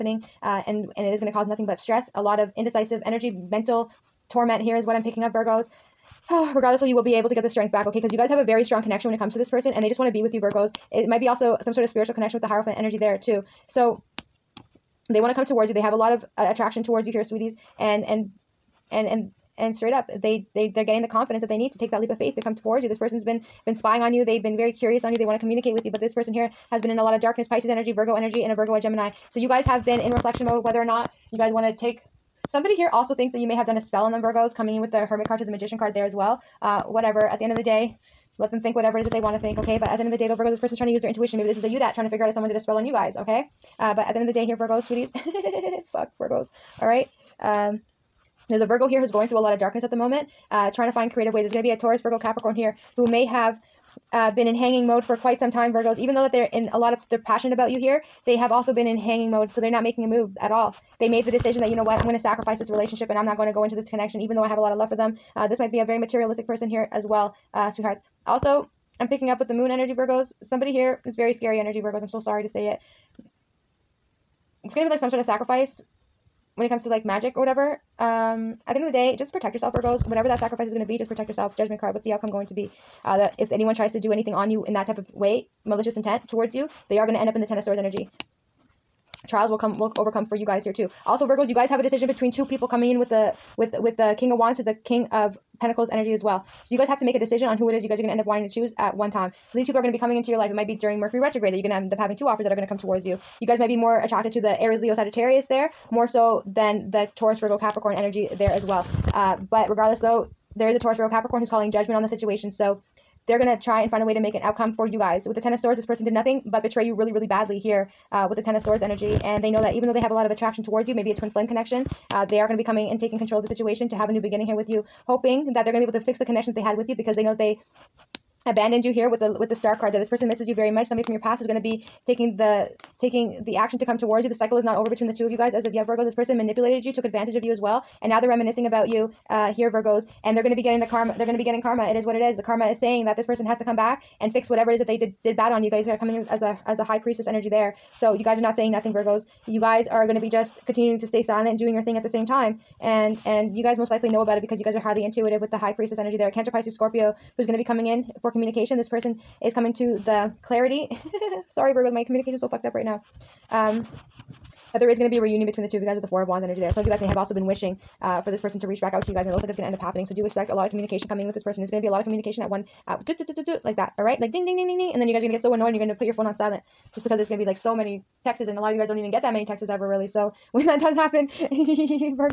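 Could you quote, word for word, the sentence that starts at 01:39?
So these people are going to be coming into your life.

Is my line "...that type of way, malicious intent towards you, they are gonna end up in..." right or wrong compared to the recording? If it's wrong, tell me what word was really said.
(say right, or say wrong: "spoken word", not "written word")
right.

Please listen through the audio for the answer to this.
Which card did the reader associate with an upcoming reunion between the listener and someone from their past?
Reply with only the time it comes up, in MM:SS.
02:46.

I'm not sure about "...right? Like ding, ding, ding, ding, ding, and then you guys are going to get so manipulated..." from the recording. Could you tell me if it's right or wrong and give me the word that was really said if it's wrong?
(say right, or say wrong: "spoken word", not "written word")
wrong: "annoyed", not "manipulated".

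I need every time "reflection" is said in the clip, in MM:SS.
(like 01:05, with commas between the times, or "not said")
00:30.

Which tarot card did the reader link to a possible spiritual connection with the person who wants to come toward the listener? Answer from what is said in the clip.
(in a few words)
Hierophant.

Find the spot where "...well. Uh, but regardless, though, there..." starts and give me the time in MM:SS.
01:48.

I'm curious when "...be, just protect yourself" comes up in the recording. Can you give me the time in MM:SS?
01:20.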